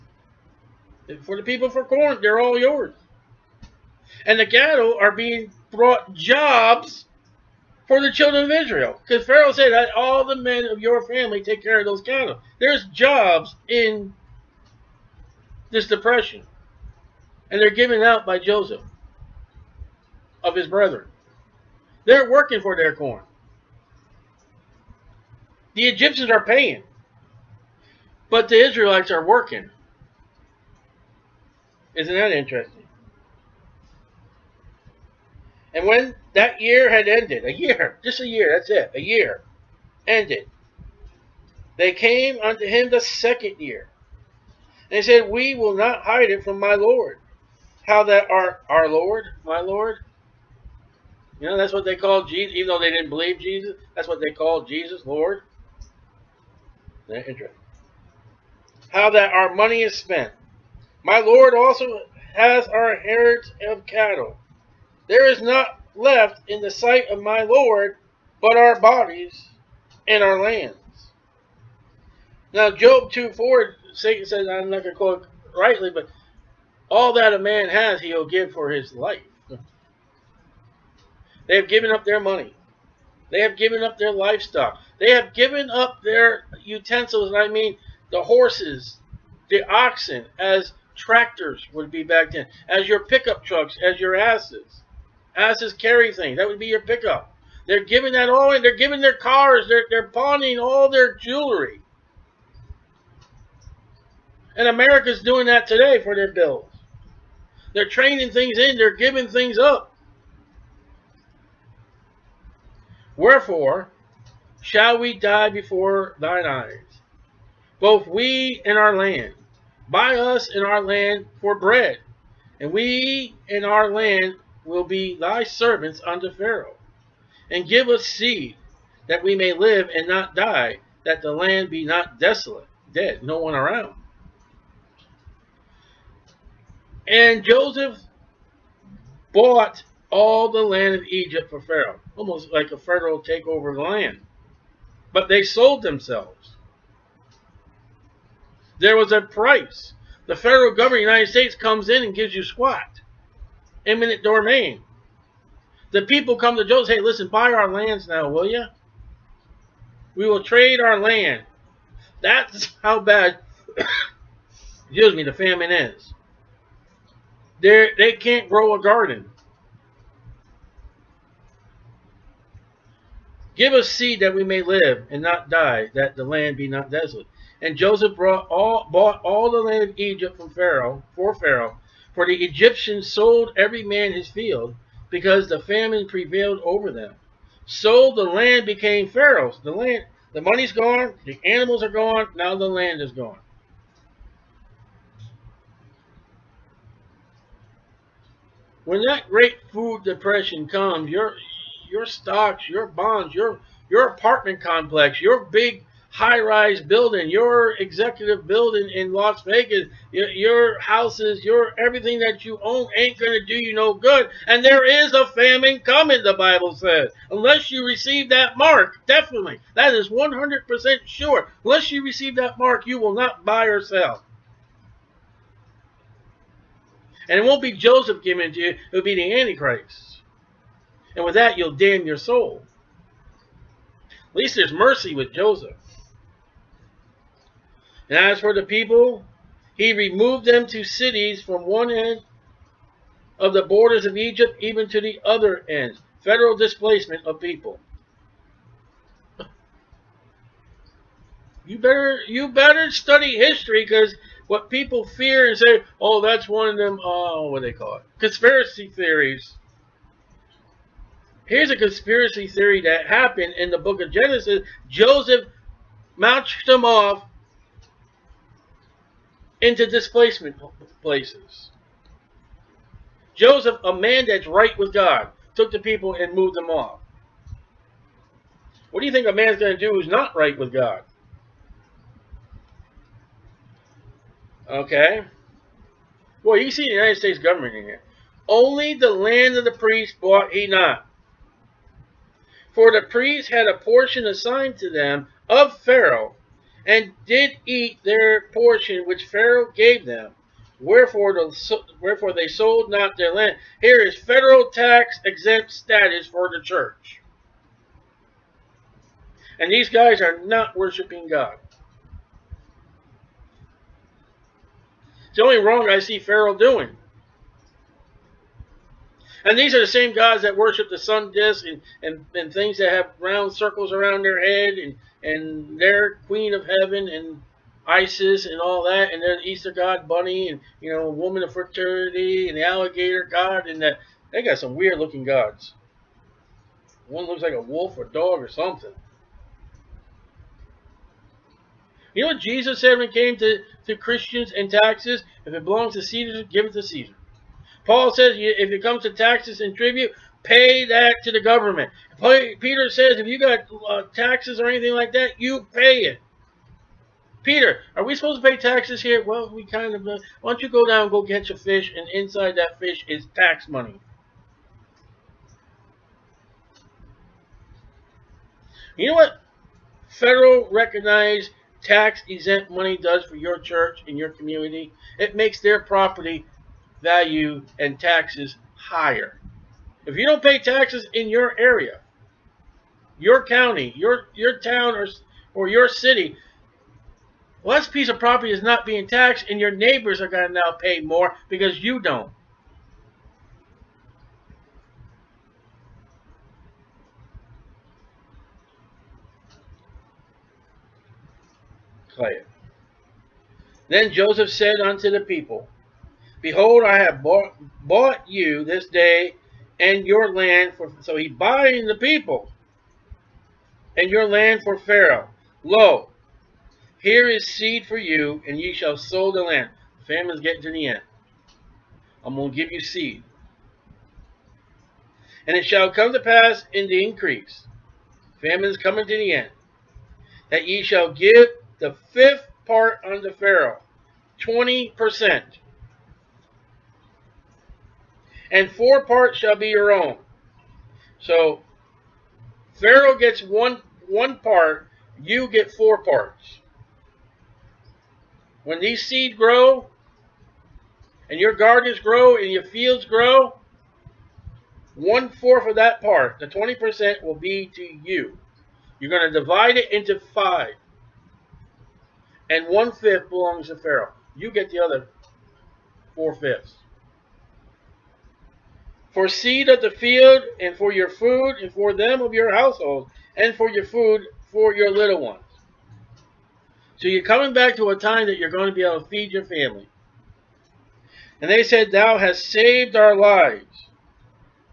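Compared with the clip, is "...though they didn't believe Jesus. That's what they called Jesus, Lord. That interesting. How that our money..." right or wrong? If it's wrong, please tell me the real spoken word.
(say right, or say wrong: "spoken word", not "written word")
right.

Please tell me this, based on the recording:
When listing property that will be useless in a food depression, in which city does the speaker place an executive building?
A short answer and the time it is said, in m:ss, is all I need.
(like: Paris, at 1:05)
Las Vegas, at 3:29.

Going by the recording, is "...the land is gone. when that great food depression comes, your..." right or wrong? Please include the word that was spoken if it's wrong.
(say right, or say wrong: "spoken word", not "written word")
right.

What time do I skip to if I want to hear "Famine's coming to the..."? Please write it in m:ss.
7:08.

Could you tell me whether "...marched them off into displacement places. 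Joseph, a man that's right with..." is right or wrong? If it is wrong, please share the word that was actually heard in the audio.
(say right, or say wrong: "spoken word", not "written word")
right.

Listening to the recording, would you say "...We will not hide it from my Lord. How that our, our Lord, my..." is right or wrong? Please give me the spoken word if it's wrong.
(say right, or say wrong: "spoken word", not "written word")
right.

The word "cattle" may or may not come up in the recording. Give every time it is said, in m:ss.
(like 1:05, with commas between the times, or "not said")
0:04, 0:12, 1:03.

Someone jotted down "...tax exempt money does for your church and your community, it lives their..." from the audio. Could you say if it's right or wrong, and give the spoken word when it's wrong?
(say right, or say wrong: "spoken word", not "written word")
wrong: "makes", not "lives".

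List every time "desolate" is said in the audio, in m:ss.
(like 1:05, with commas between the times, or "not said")
2:12, 2:56.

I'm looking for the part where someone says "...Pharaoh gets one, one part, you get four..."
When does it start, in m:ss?
7:22.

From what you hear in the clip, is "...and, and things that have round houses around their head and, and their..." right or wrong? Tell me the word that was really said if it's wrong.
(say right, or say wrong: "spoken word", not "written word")
wrong: "circles", not "houses".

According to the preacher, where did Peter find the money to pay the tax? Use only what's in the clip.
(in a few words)
inside that fish.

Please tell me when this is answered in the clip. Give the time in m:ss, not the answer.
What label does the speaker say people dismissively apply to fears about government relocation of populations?
4:18.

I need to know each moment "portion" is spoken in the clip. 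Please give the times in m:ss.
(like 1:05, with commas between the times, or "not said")
4:53, 4:58.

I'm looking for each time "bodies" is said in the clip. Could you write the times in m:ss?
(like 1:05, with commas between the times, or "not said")
1:08.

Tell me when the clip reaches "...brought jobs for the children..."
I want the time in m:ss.
0:05.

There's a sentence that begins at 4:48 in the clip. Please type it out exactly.
Only the land of the priests bought he not.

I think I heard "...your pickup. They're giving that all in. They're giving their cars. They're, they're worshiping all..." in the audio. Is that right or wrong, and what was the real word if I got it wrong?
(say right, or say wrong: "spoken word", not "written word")
wrong: "pawning", not "worshiping".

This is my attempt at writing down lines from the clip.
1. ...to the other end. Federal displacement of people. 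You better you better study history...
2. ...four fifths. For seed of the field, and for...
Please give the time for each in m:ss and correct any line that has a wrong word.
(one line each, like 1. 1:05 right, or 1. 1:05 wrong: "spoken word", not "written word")
1. 4:04 right
2. 7:46 right.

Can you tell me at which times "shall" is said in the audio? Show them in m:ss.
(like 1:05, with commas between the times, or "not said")
1:54, 6:58, 7:05, 7:10, 7:19.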